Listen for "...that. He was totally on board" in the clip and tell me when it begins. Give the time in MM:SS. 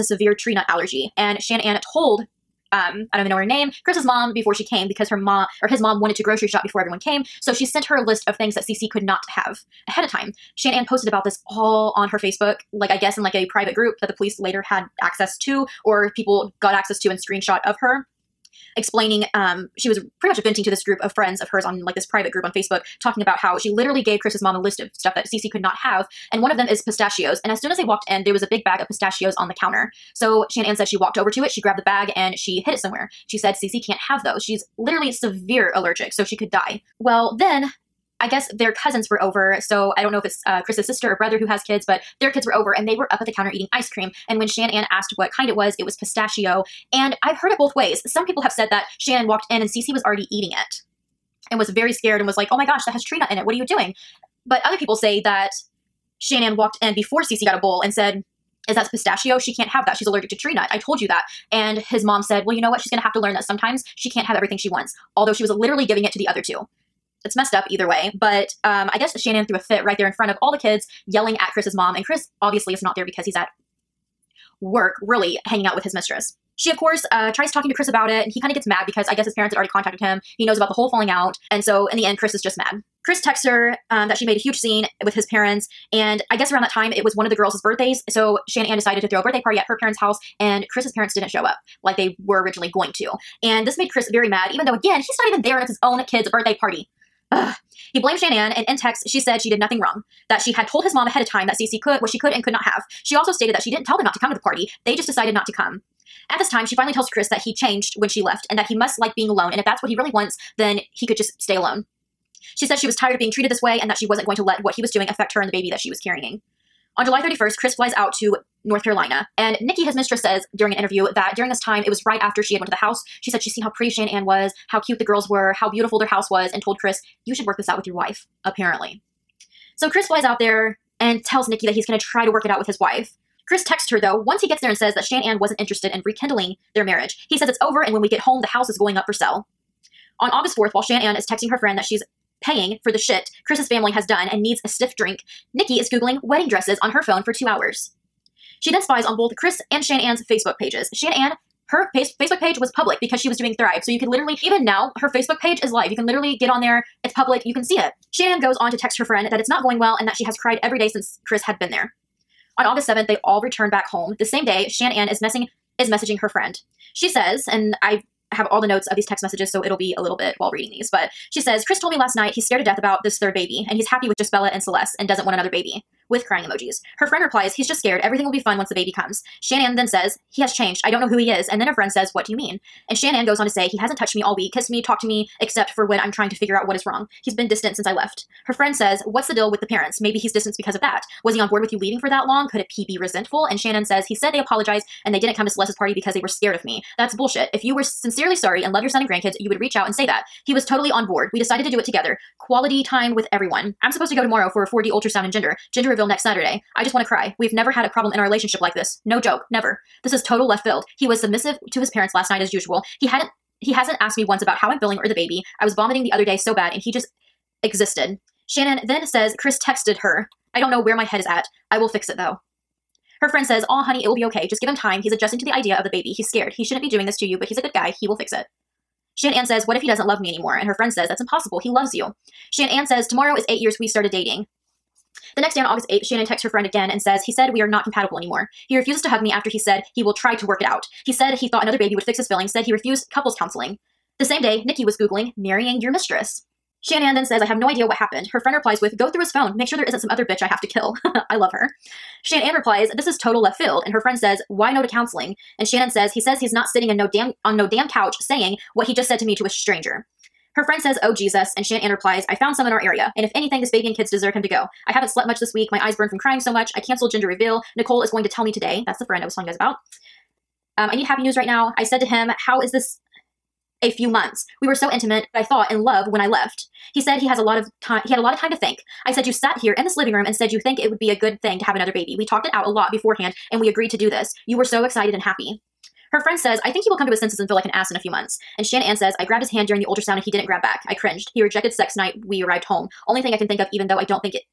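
03:20.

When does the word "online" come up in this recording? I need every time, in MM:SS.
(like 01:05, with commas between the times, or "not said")
not said.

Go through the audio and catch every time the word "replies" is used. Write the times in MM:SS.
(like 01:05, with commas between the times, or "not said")
02:57, 04:08, 04:12, 04:21.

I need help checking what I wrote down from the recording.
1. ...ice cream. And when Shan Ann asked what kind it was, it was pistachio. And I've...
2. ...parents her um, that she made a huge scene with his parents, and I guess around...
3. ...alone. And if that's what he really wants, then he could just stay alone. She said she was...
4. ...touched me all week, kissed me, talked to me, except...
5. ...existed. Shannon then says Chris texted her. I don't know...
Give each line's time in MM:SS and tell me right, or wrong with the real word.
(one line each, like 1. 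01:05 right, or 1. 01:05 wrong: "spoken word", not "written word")
1. 00:43 right
2. 01:23 wrong: "texts", not "parents"
3. 01:49 right
4. 03:03 right
5. 03:37 right.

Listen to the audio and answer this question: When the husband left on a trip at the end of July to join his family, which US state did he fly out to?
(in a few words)
North Carolina.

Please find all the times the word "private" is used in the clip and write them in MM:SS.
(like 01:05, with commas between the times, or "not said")
00:13, 00:22.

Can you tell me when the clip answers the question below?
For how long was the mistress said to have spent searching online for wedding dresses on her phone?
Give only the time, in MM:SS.
02:27.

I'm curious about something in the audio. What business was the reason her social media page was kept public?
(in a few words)
Thrive.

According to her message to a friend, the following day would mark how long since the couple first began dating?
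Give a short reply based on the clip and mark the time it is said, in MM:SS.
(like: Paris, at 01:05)
8 years, at 03:53.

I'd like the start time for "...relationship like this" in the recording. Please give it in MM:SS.
03:28.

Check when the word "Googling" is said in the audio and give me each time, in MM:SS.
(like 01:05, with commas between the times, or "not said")
02:25, 04:04.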